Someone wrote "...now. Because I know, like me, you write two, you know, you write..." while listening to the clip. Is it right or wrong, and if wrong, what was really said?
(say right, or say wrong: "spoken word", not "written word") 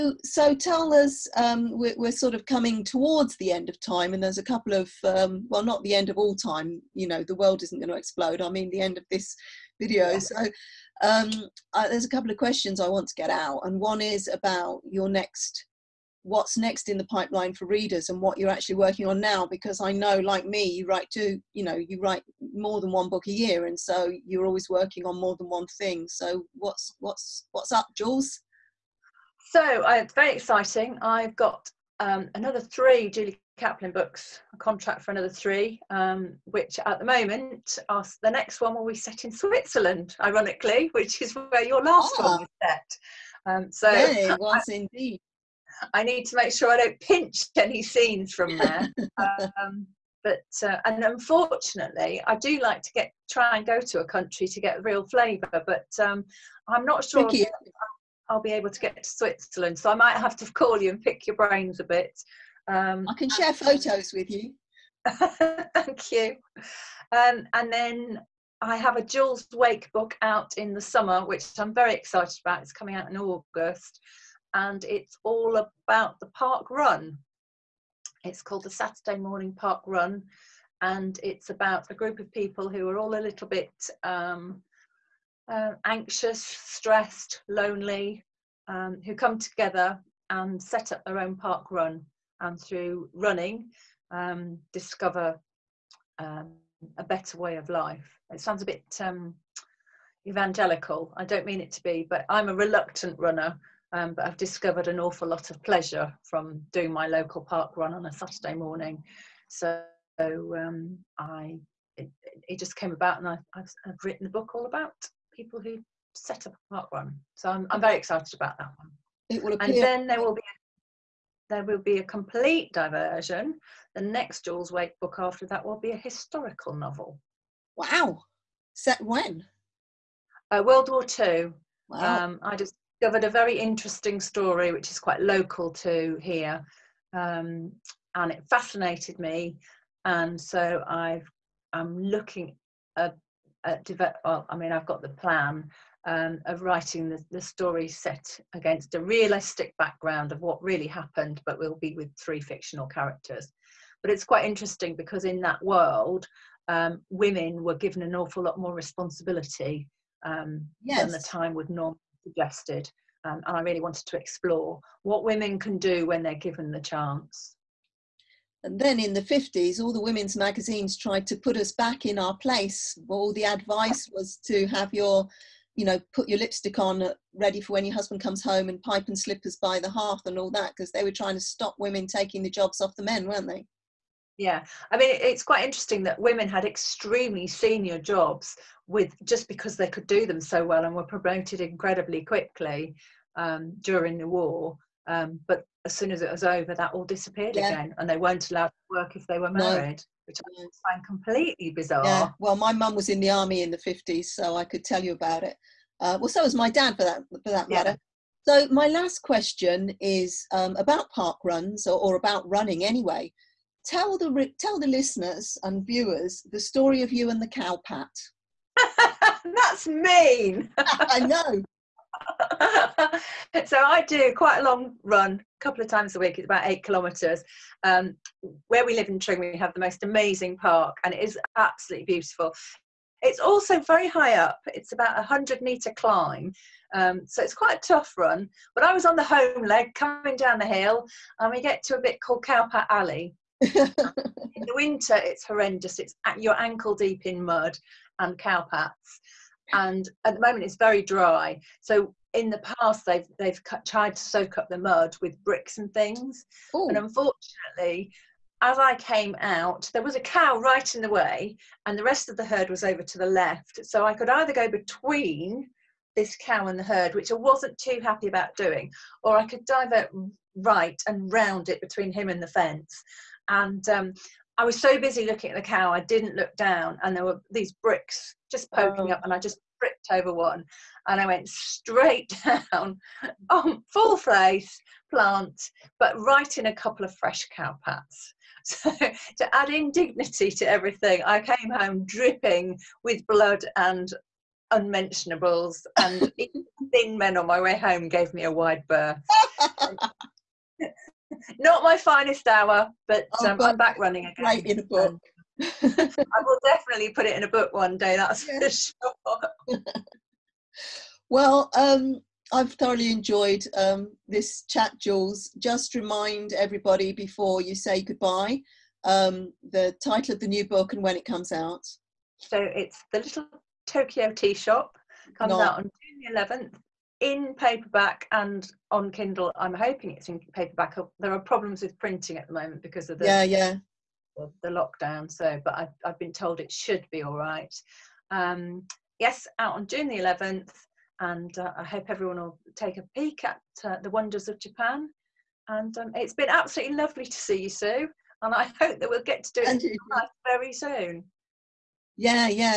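right.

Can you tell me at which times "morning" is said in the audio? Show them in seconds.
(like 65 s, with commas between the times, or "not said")
79 s, 108 s.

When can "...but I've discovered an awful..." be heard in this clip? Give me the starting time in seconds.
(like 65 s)
104 s.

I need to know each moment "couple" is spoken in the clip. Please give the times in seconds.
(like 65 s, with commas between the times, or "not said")
4 s, 12 s, 225 s, 286 s.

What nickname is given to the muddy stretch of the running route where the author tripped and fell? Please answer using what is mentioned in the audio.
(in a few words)
Cowpat Alley.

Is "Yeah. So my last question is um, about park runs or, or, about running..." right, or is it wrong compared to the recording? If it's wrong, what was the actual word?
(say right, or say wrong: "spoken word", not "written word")
right.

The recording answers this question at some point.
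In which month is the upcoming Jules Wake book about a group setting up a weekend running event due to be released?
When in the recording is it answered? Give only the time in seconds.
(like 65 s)
73 s.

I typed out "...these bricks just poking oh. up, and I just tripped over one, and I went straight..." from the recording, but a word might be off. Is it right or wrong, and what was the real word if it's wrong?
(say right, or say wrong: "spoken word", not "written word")
right.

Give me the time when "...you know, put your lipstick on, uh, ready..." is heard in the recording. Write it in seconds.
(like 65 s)
175 s.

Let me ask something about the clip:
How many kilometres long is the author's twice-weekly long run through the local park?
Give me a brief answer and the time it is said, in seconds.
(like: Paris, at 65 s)
8, at 226 s.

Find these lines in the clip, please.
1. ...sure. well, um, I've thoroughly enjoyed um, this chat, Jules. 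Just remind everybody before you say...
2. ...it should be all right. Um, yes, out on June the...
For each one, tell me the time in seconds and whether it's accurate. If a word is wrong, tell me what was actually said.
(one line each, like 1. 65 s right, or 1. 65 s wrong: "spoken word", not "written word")
1. 309 s right
2. 336 s right.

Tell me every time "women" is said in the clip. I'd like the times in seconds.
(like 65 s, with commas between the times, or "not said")
157 s, 165 s, 170 s, 181 s, 186 s.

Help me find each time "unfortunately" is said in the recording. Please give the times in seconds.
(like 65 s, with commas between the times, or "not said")
51 s, 256 s.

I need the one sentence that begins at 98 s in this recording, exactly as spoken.
It sounds a bit um, evangelical.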